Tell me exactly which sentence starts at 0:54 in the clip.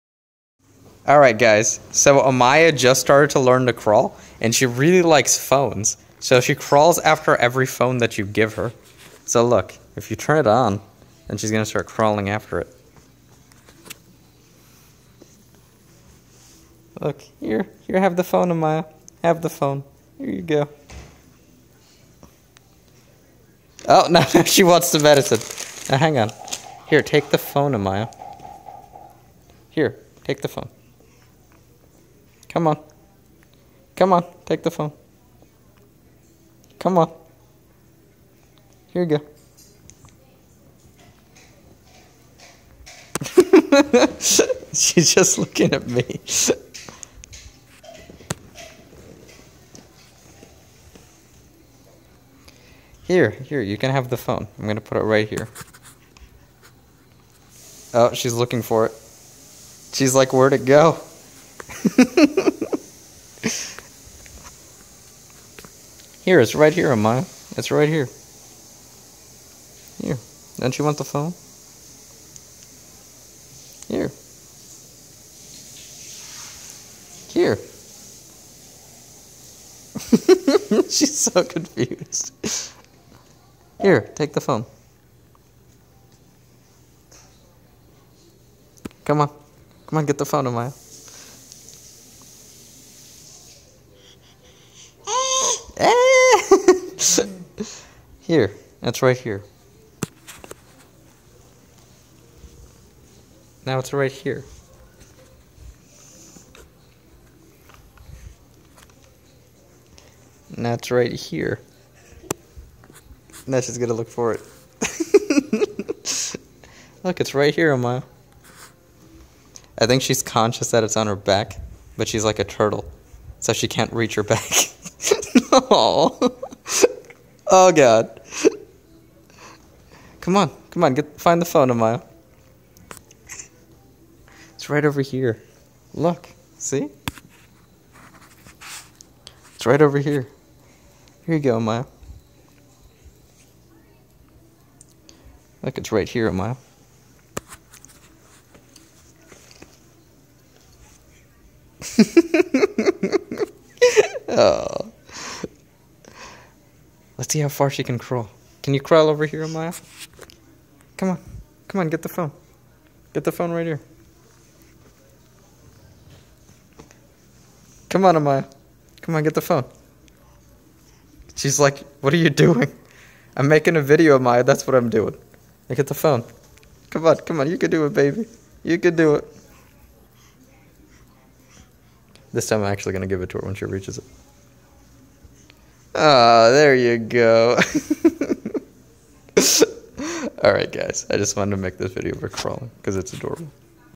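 I'm going to put it right here.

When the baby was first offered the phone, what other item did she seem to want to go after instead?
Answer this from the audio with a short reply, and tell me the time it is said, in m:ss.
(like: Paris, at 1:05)
medicine, at 0:24.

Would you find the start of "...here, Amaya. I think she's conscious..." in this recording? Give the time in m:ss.
1:57.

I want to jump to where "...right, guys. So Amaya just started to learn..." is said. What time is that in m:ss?
0:01.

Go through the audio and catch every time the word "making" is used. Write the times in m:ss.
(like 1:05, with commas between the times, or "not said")
2:53.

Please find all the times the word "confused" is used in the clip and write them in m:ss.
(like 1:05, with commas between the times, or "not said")
1:21.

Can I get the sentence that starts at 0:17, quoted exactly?
Look, here, here, have the phone, Amaya.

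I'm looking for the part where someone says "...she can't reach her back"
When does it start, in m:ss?
2:03.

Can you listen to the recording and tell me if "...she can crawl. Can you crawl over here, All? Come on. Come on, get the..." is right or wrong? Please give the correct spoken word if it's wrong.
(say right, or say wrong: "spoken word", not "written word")
wrong: "Amaya", not "All".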